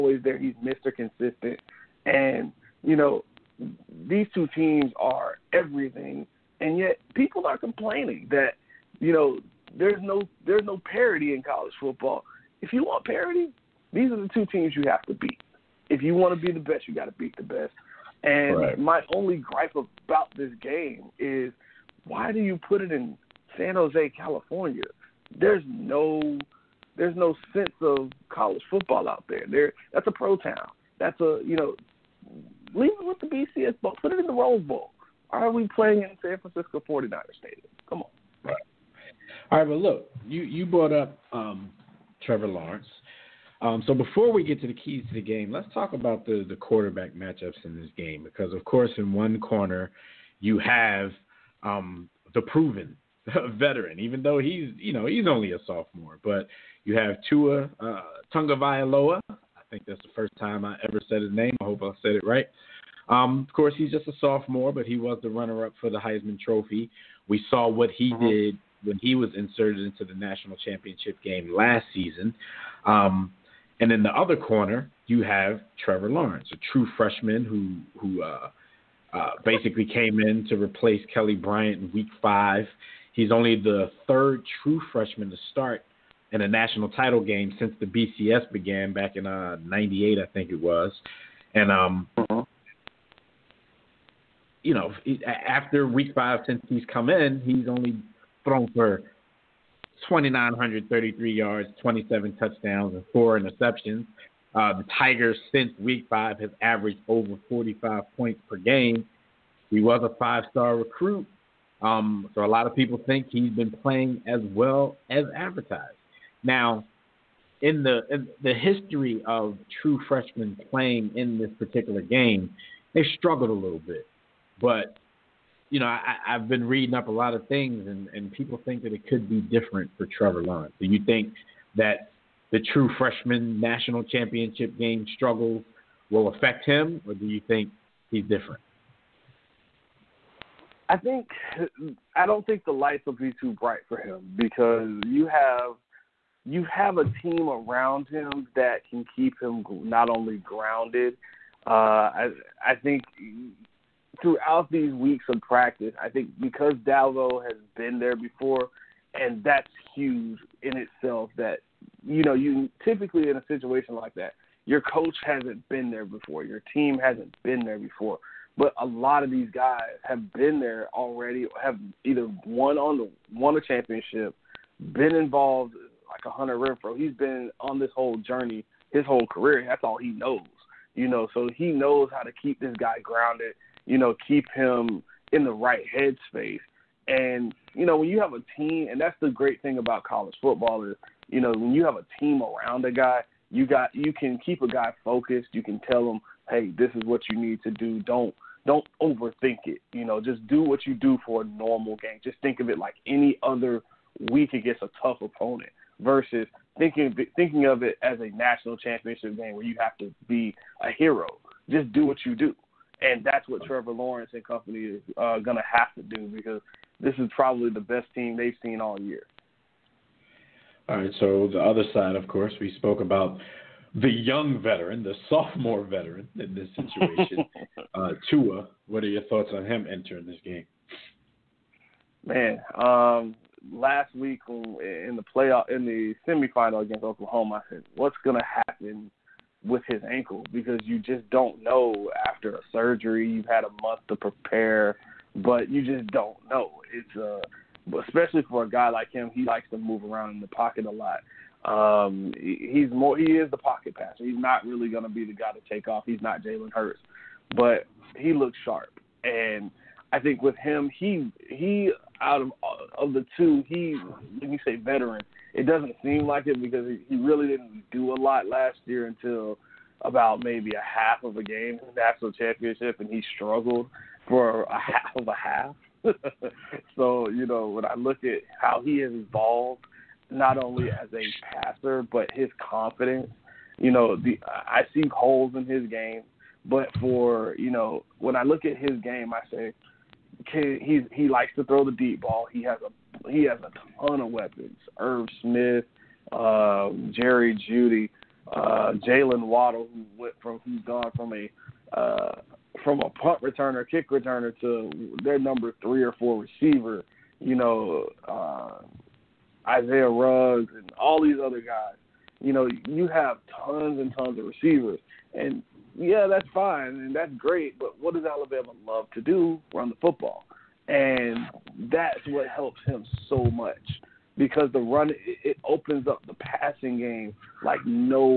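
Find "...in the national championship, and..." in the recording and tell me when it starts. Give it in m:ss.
4:31.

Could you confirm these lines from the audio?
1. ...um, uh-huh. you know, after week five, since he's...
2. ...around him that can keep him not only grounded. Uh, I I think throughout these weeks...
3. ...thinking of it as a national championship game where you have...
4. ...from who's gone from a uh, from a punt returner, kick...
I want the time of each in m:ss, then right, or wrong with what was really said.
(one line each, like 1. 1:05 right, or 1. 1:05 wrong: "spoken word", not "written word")
1. 1:31 right
2. 2:27 right
3. 3:27 right
4. 5:00 right.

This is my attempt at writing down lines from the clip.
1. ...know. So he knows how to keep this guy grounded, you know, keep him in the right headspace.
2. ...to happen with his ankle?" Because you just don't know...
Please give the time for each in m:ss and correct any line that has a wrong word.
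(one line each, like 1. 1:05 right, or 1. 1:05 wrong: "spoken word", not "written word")
1. 3:01 right
2. 3:58 right.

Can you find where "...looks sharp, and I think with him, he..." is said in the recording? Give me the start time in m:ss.
4:18.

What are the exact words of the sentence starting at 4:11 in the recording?
Um, he's more he is the pocket passer.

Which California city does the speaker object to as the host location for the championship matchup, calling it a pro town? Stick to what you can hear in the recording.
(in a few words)
San Jose.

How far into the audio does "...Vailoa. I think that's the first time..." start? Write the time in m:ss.
0:58.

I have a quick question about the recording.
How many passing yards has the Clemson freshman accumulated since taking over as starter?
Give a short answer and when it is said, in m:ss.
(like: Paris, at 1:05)
2,933, at 1:40.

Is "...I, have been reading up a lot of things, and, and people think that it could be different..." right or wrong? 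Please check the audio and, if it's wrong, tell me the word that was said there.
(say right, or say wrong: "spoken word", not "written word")
right.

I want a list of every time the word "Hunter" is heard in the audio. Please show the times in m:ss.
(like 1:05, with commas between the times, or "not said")
2:56.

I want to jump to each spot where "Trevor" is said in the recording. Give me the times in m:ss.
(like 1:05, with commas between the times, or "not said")
0:42, 1:15, 2:10, 3:33.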